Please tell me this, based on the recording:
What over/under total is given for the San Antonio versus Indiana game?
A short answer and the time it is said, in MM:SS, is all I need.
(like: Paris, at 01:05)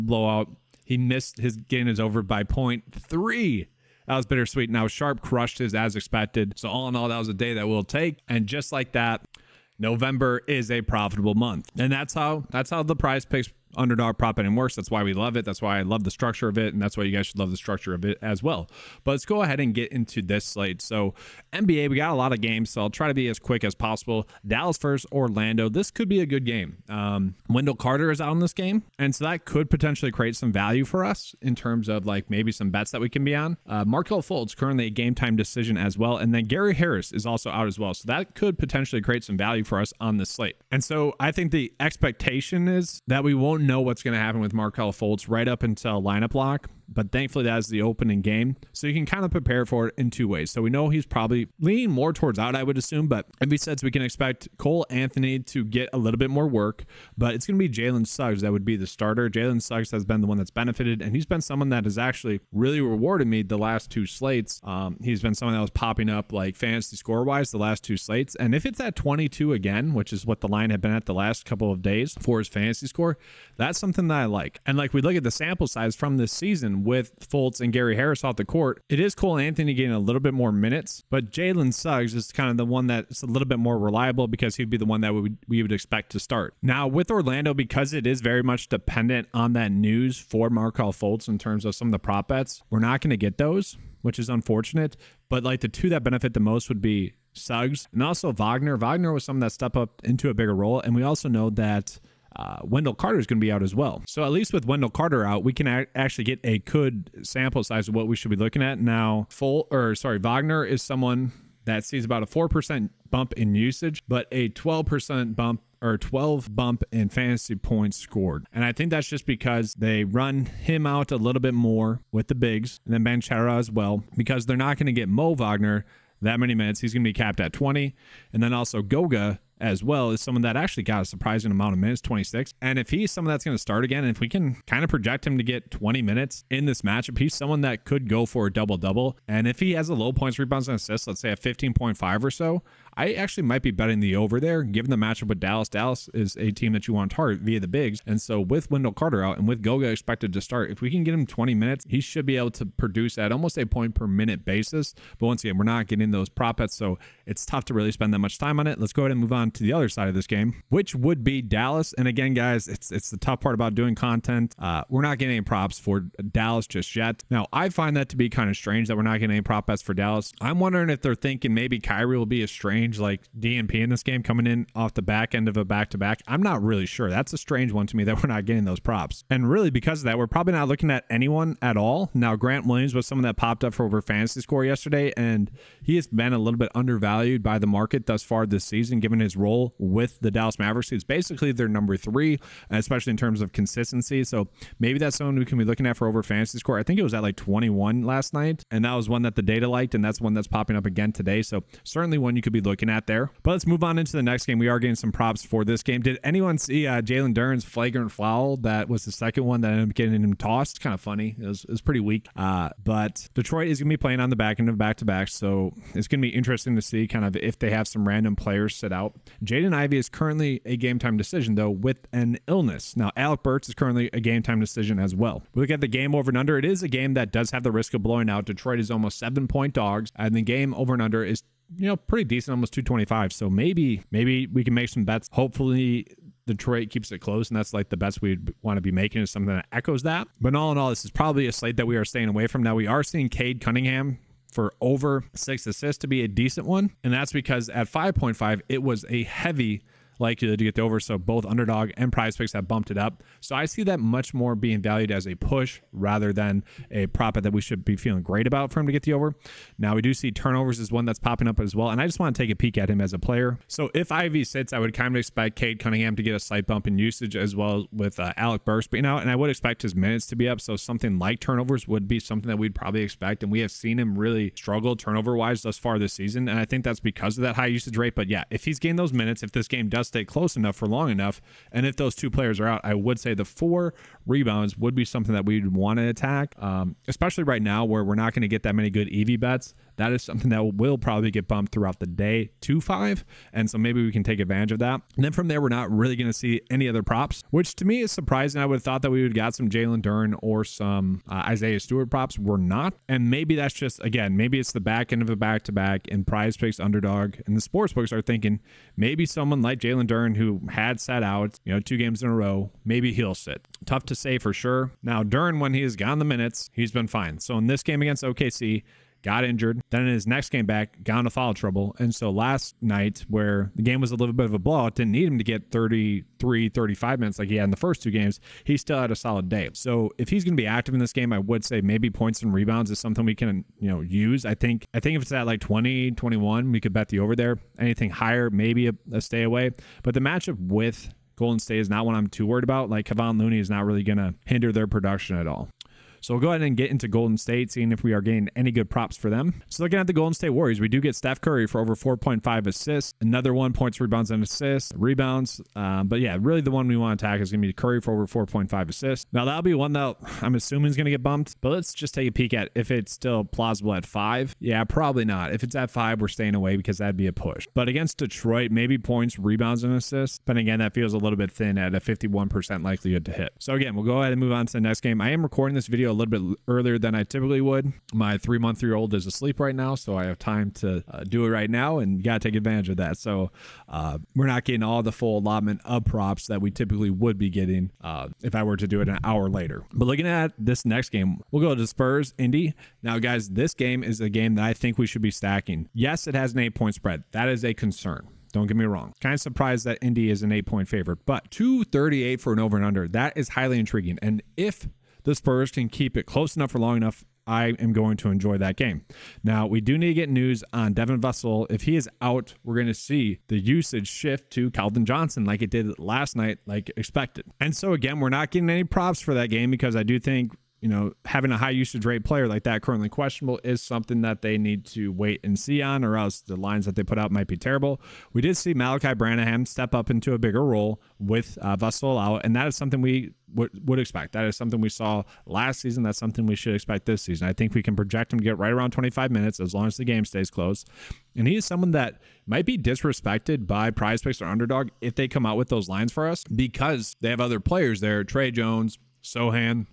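238, at 06:41.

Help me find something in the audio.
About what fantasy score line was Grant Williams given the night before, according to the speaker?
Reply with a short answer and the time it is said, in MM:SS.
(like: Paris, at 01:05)
21, at 03:16.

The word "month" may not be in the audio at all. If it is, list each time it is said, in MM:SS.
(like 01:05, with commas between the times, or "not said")
00:11, 06:18.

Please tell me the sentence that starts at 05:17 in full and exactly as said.
So in this game against OKC, got injured.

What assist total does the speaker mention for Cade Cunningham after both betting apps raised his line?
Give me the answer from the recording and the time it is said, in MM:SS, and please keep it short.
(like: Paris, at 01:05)
6, at 04:04.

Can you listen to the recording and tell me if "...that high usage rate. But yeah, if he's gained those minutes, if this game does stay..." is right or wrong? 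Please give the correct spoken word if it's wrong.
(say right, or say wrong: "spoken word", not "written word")
right.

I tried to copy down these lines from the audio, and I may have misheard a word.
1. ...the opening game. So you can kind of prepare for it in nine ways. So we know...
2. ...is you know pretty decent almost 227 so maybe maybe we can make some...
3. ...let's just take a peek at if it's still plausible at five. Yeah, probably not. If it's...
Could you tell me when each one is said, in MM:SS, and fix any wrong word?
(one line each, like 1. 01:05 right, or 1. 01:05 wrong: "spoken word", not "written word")
1. 00:47 wrong: "two", not "nine"
2. 03:51 wrong: "225", not "227"
3. 06:01 right.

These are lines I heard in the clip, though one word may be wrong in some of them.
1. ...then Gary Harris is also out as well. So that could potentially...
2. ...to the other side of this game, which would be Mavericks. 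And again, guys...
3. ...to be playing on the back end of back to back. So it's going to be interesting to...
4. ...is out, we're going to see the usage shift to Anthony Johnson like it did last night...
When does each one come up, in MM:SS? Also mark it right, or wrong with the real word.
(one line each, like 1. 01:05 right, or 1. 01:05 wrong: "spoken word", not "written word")
1. 00:36 right
2. 02:39 wrong: "Dallas", not "Mavericks"
3. 03:33 right
4. 06:51 wrong: "Keldon", not "Anthony".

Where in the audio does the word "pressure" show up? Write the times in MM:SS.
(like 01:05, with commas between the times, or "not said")
not said.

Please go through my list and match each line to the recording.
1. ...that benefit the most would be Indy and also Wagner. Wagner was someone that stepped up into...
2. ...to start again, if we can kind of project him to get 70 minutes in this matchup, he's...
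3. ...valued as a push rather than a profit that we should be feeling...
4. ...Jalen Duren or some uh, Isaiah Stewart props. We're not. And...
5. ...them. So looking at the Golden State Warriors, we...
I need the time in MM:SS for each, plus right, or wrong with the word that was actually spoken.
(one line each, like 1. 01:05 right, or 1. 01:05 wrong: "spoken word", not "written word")
1. 01:35 wrong: "Suggs", not "Indy"
2. 02:13 wrong: "20", not "70"
3. 04:14 right
4. 04:59 right
5. 05:49 right.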